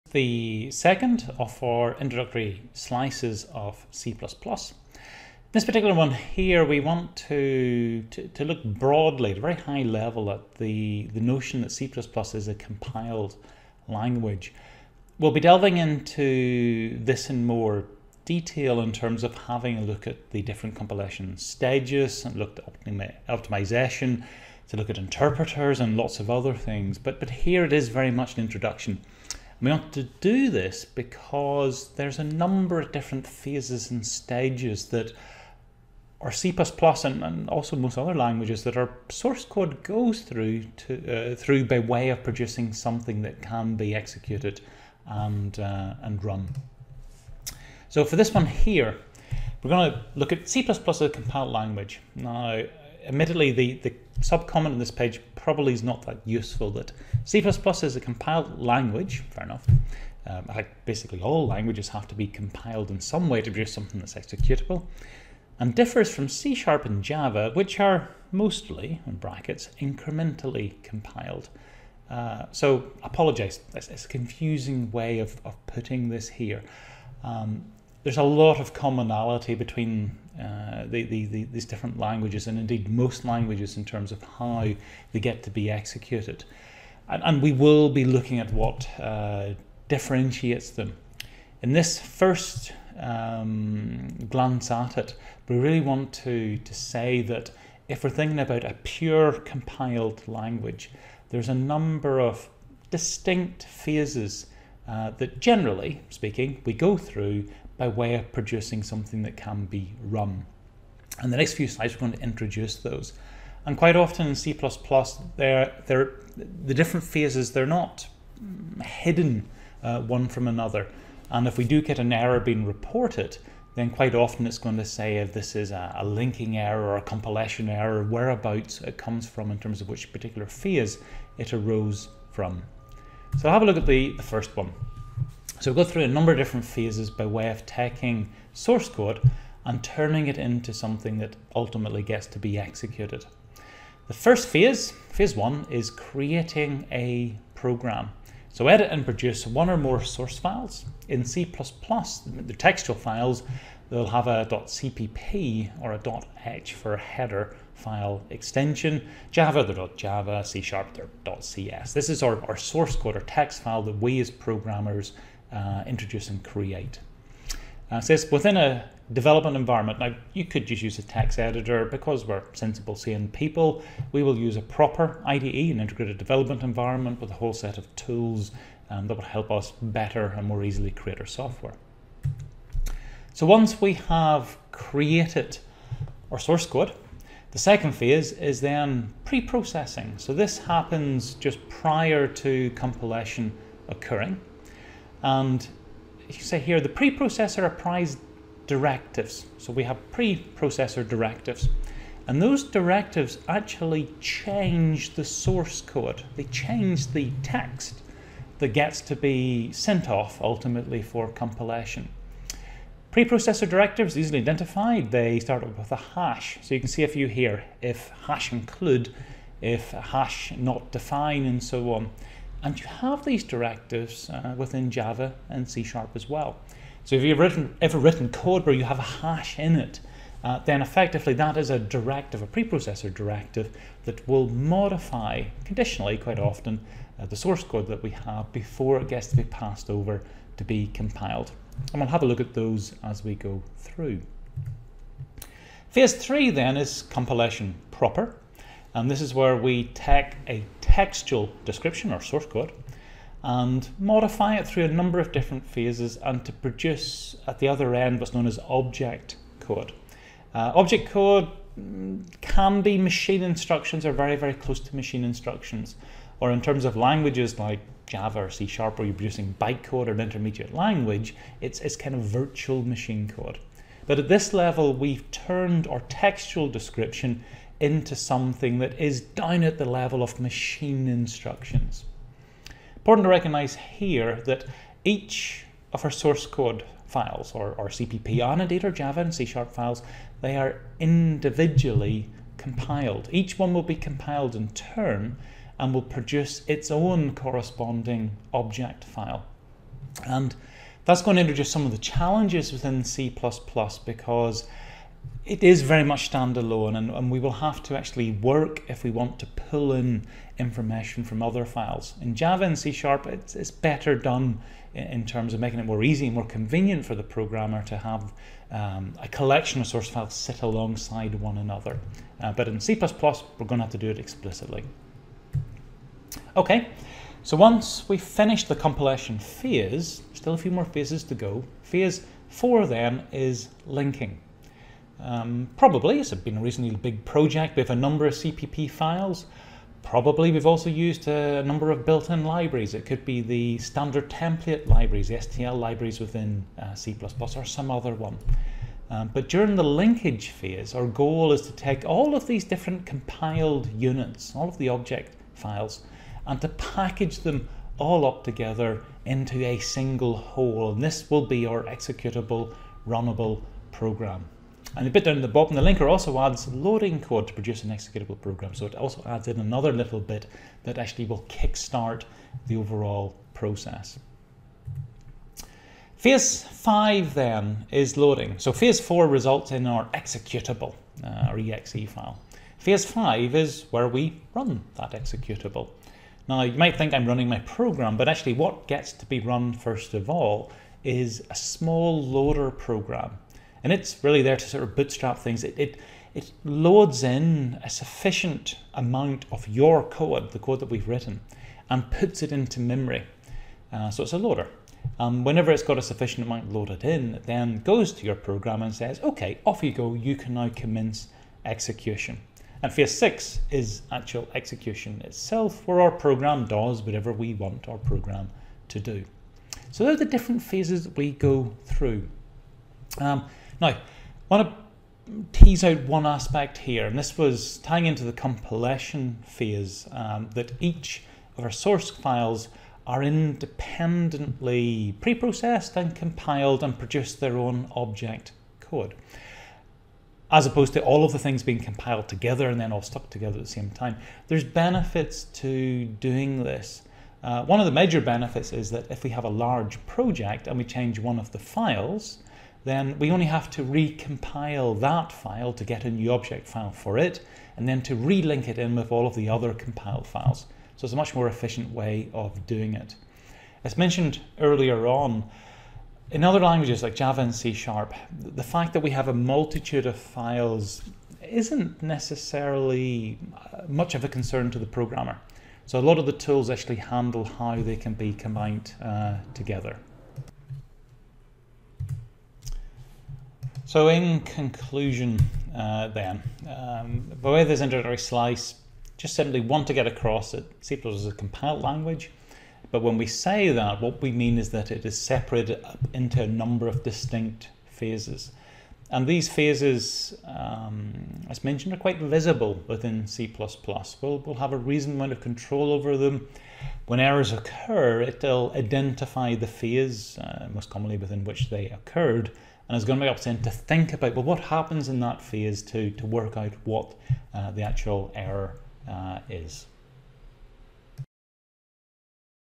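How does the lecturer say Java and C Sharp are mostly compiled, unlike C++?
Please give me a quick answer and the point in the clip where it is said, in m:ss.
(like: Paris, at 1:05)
Incrementally, at 1:09.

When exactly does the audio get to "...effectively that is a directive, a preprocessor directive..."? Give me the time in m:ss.
3:50.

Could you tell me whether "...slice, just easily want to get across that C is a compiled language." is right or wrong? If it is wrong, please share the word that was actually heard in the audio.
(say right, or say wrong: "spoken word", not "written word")
wrong: "simply", not "easily".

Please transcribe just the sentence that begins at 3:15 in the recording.
And you say here, the preprocessor applies directives.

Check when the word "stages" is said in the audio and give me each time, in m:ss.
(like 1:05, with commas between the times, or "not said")
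0:21, 0:34.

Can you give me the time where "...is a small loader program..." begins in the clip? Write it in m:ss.
6:31.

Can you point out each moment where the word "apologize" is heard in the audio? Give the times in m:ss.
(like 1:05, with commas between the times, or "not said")
1:13.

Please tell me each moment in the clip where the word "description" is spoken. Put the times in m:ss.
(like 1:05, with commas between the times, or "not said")
4:11, 4:36.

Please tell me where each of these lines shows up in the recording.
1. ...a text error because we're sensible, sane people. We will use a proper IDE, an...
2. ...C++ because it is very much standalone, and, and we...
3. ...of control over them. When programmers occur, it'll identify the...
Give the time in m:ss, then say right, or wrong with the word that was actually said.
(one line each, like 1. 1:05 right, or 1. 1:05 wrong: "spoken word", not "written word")
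1. 2:50 wrong: "editor", not "error"
2. 5:03 right
3. 8:25 wrong: "errors", not "programmers".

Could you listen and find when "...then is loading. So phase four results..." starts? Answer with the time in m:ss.
6:17.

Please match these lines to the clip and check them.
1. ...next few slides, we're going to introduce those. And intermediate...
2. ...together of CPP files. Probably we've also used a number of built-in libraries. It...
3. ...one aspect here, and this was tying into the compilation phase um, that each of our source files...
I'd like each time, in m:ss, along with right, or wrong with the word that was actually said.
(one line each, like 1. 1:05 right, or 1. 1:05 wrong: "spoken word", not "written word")
1. 1:51 wrong: "quite", not "intermediate"
2. 5:37 wrong: "number", not "together"
3. 7:06 right.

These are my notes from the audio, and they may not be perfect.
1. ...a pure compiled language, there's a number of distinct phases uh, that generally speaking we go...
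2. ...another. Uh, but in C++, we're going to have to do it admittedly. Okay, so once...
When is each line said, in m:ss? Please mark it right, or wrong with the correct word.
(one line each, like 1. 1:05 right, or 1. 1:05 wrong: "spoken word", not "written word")
1. 1:38 right
2. 5:21 wrong: "explicitly", not "admittedly".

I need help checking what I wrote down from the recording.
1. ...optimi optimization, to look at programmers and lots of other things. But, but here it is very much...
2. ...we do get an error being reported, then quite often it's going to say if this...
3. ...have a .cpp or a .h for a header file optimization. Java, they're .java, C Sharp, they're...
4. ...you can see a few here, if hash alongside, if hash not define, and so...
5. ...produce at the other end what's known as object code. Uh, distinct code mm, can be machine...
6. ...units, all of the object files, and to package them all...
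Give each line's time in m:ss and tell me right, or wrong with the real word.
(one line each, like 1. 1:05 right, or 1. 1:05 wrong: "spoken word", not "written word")
1. 0:22 wrong: "interpreters", not "programmers"
2. 2:01 right
3. 2:34 wrong: "extension", not "optimization"
4. 3:36 wrong: "include", not "alongside"
5. 4:16 wrong: "object", not "distinct"
6. 5:53 right.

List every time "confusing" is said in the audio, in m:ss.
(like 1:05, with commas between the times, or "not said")
1:14.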